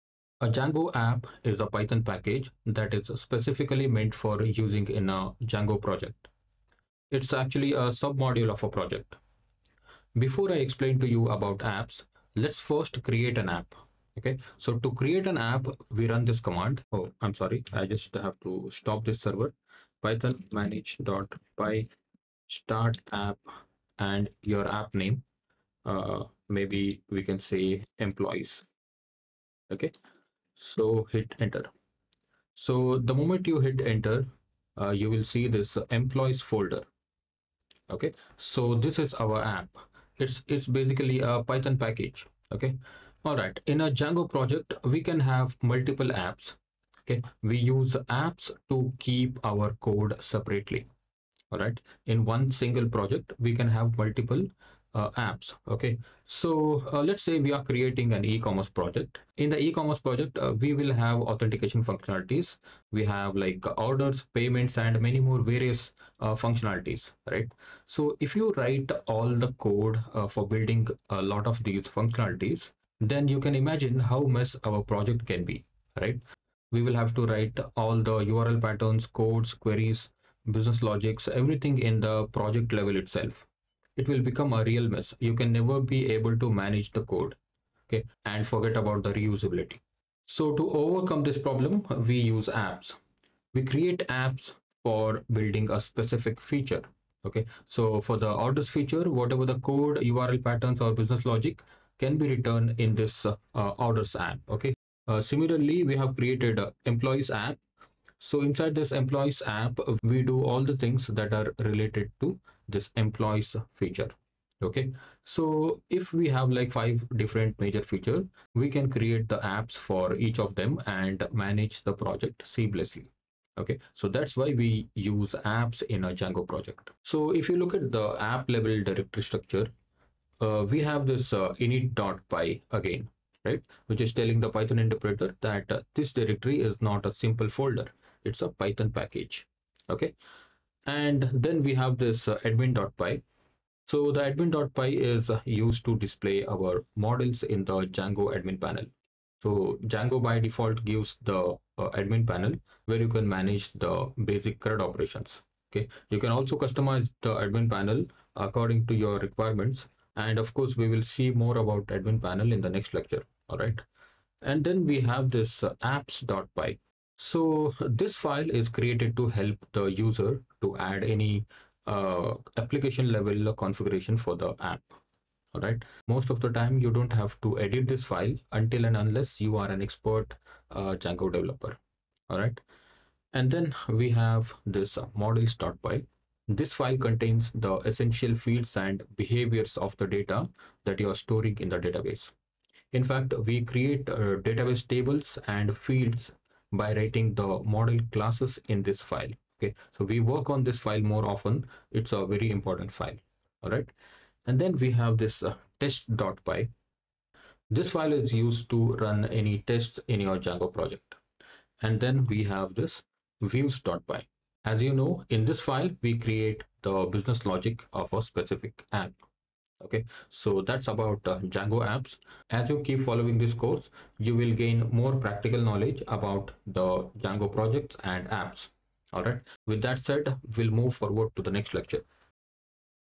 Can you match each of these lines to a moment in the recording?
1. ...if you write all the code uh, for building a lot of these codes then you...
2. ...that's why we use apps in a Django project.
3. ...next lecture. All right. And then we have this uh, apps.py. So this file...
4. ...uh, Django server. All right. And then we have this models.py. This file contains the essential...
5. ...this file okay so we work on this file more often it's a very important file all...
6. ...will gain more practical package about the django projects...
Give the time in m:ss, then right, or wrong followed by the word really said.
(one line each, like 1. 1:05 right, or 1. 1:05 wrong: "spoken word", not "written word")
1. 1:08 wrong: "functionalities", not "codes"
2. 2:04 right
3. 2:42 right
4. 3:00 wrong: "developer", not "server"
5. 3:18 right
6. 3:44 wrong: "knowledge", not "package".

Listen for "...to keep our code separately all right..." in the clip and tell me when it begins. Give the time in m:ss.
0:48.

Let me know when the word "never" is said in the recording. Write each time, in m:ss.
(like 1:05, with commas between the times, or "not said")
1:25.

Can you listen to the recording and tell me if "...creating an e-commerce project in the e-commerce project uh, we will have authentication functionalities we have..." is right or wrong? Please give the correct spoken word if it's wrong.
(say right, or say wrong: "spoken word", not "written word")
right.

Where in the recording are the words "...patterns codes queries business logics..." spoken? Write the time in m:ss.
1:18.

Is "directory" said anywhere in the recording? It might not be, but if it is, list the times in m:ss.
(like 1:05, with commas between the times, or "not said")
2:08, 2:16.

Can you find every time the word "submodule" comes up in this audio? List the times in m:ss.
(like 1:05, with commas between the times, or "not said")
0:08.